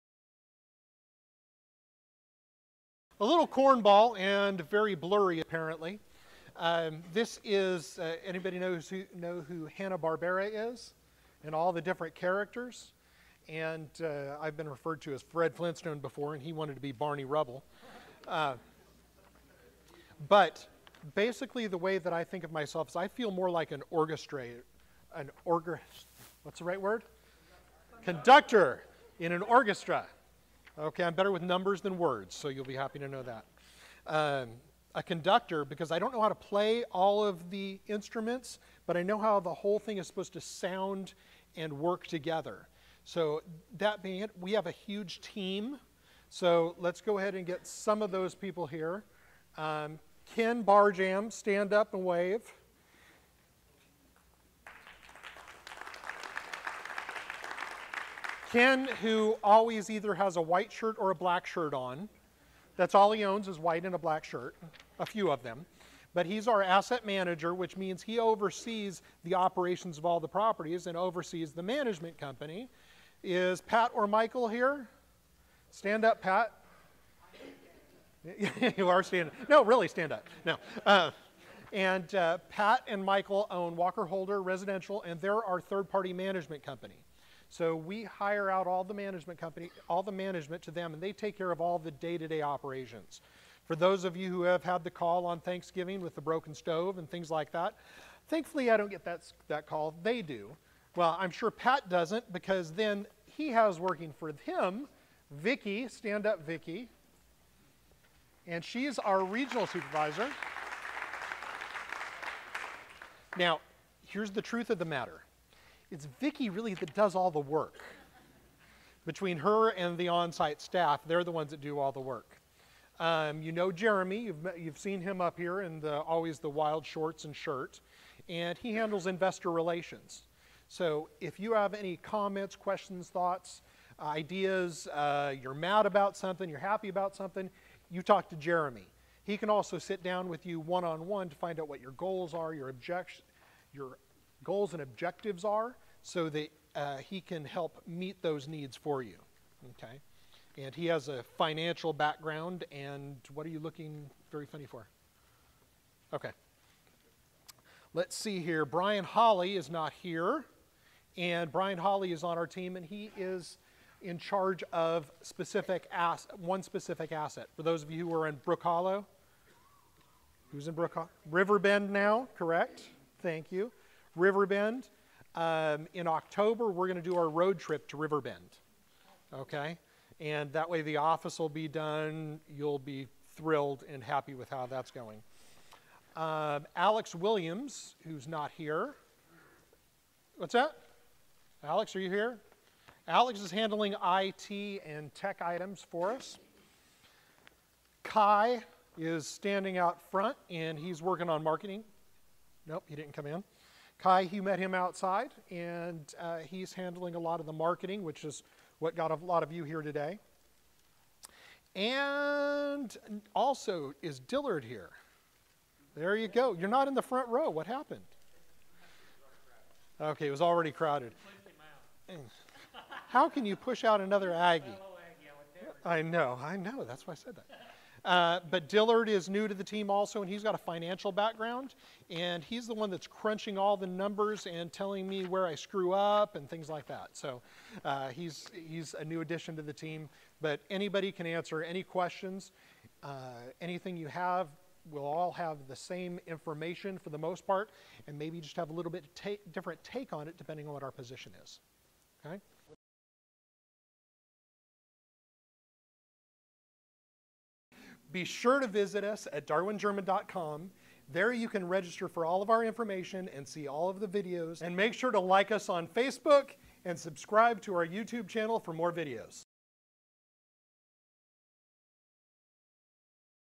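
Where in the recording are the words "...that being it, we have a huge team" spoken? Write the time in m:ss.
0:43.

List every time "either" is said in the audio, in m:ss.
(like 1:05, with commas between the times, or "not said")
0:59.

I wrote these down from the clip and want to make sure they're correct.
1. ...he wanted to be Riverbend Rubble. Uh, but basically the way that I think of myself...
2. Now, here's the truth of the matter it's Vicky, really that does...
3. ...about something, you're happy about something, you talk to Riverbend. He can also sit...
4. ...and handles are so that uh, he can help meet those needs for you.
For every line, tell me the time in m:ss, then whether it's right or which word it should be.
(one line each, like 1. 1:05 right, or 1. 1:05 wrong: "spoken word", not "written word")
1. 0:16 wrong: "Barney", not "Riverbend"
2. 1:53 right
3. 2:15 wrong: "Jeremy", not "Riverbend"
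4. 2:24 wrong: "objectives", not "handles".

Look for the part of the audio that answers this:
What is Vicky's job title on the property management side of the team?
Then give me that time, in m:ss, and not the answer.
1:49.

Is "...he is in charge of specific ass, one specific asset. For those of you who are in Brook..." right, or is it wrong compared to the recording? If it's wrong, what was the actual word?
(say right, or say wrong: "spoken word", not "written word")
right.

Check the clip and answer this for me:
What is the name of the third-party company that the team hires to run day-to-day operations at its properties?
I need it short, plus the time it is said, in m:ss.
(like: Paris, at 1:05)
Walker Holder Residential, at 1:23.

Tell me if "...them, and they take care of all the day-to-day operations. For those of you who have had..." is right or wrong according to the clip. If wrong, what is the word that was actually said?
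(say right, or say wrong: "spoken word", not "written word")
right.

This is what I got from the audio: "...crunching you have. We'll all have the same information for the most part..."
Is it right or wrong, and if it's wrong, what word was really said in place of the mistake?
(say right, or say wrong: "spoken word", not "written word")
wrong: "anything", not "crunching".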